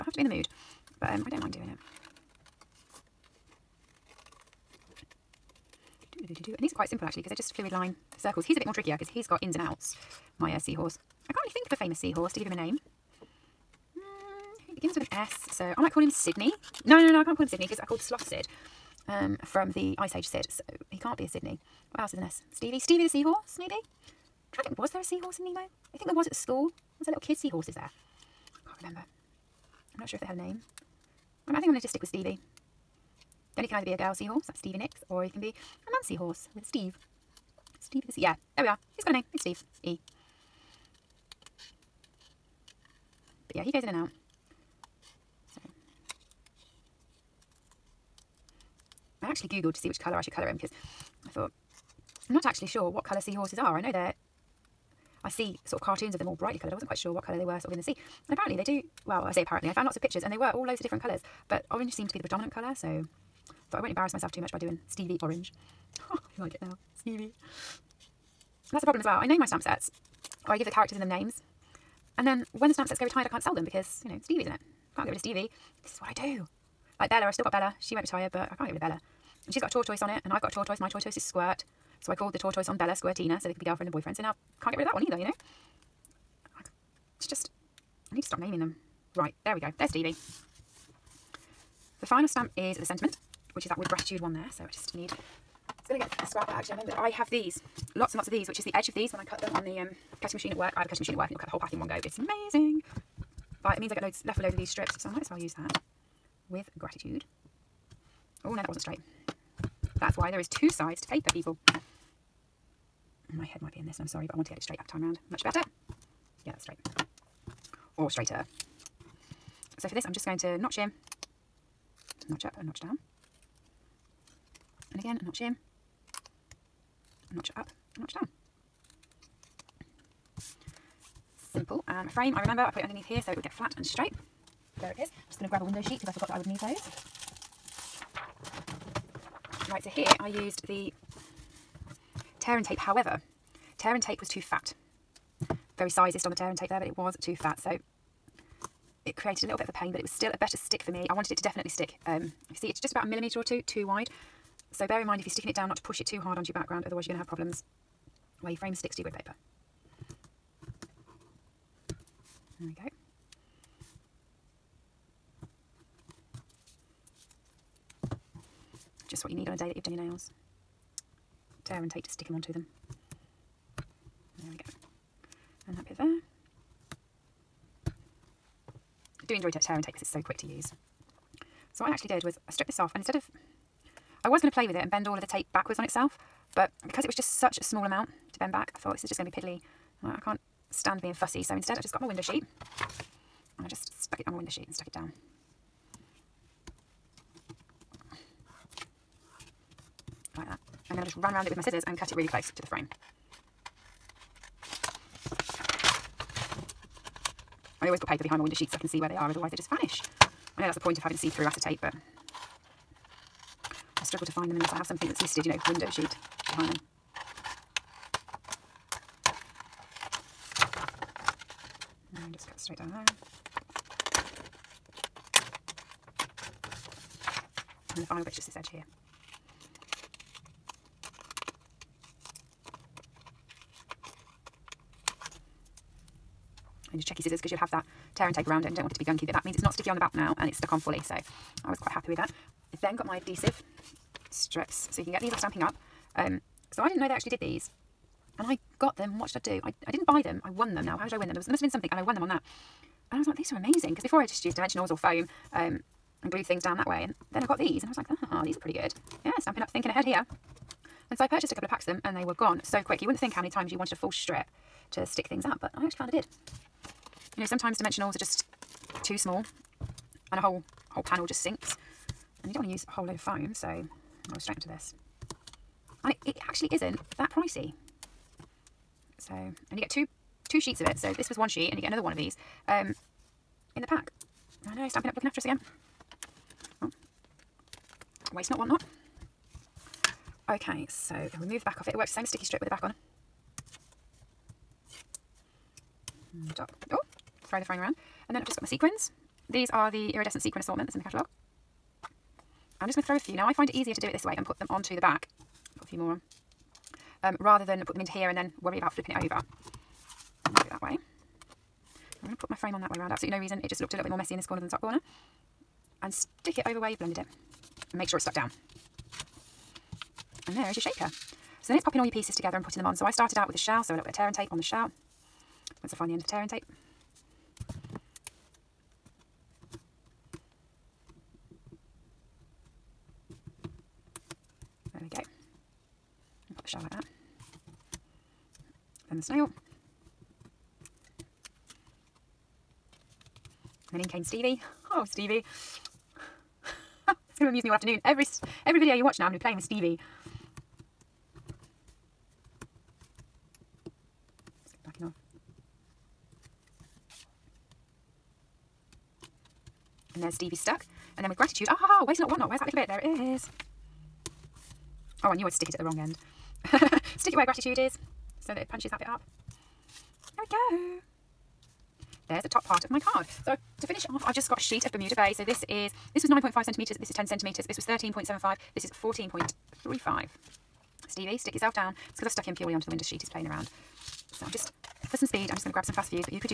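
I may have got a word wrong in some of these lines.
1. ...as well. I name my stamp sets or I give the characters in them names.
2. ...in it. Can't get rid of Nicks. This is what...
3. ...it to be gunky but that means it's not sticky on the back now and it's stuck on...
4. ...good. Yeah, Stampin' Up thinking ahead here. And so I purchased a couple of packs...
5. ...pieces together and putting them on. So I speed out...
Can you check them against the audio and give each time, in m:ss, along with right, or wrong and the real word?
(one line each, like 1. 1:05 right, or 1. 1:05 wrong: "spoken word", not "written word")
1. 1:08 right
2. 1:14 wrong: "Stevie", not "Nicks"
3. 3:58 right
4. 4:18 right
5. 5:22 wrong: "started", not "speed".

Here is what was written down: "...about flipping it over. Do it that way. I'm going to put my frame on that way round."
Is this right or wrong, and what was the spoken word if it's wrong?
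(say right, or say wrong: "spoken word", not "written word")
right.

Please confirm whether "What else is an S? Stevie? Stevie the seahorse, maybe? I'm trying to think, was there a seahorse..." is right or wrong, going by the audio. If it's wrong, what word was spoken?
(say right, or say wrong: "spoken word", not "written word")
right.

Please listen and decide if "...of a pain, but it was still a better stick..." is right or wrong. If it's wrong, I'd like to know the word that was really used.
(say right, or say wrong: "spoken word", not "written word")
right.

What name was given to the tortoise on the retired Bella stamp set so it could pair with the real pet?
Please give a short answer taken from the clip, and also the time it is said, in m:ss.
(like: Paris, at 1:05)
Squirtina, at 1:22.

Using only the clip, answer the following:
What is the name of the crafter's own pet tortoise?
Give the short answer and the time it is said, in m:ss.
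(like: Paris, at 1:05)
Squirt, at 1:21.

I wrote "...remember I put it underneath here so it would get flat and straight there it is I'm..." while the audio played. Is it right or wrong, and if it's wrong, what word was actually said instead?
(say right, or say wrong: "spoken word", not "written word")
right.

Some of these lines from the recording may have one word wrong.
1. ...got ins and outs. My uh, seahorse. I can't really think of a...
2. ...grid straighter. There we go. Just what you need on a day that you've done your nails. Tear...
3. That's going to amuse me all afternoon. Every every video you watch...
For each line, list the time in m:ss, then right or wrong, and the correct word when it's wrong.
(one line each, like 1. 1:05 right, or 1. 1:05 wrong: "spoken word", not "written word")
1. 0:09 right
2. 2:39 wrong: "paper", not "straighter"
3. 5:47 right.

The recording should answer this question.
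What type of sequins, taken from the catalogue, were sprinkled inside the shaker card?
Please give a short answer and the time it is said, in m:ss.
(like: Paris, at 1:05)
Iridescent sequin assortment, at 5:00.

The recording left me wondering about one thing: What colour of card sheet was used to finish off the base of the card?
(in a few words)
Bermuda Bay.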